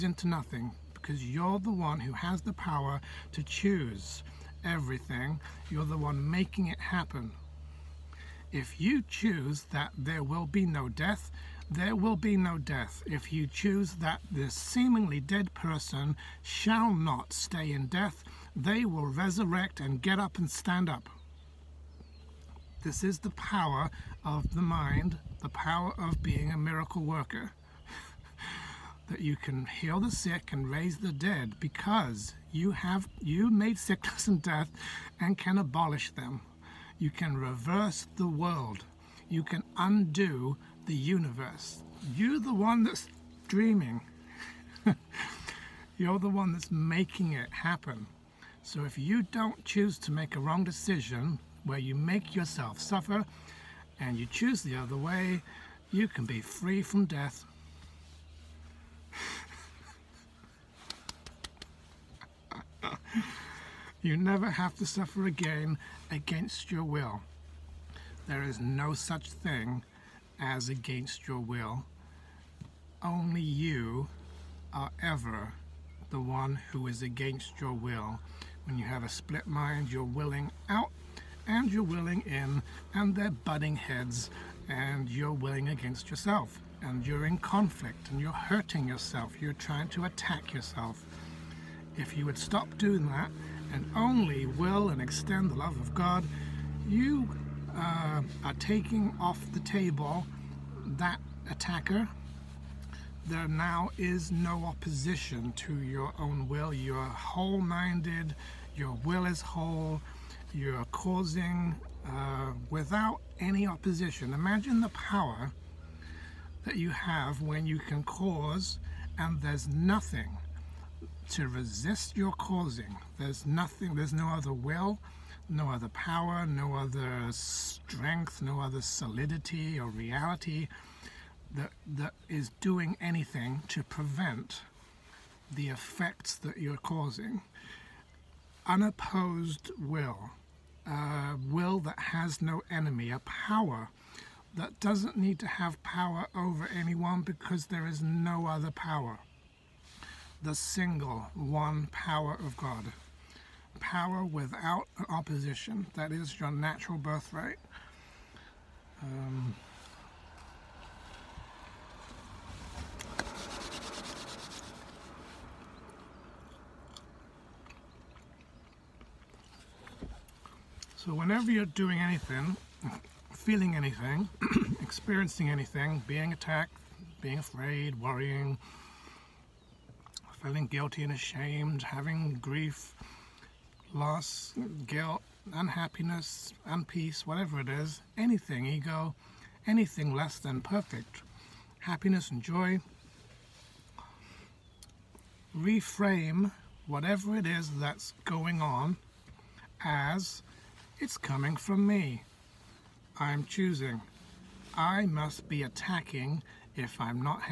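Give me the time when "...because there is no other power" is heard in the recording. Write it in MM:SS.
02:27.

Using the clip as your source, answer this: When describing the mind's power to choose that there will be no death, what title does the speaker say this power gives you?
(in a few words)
miracle worker.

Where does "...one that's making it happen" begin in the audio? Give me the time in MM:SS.
00:46.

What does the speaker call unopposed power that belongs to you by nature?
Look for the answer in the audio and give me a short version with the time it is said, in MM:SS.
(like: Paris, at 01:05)
natural birthright, at 02:36.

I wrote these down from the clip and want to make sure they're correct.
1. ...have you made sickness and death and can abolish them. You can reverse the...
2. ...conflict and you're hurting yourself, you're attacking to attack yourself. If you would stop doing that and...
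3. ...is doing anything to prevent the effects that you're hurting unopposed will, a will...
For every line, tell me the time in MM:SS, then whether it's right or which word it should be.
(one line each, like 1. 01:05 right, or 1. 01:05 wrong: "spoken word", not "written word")
1. 00:32 right
2. 01:27 wrong: "trying", not "attacking"
3. 02:12 wrong: "causing", not "hurting".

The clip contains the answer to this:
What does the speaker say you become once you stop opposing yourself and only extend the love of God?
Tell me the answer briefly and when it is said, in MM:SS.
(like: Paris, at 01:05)
whole minded, at 01:47.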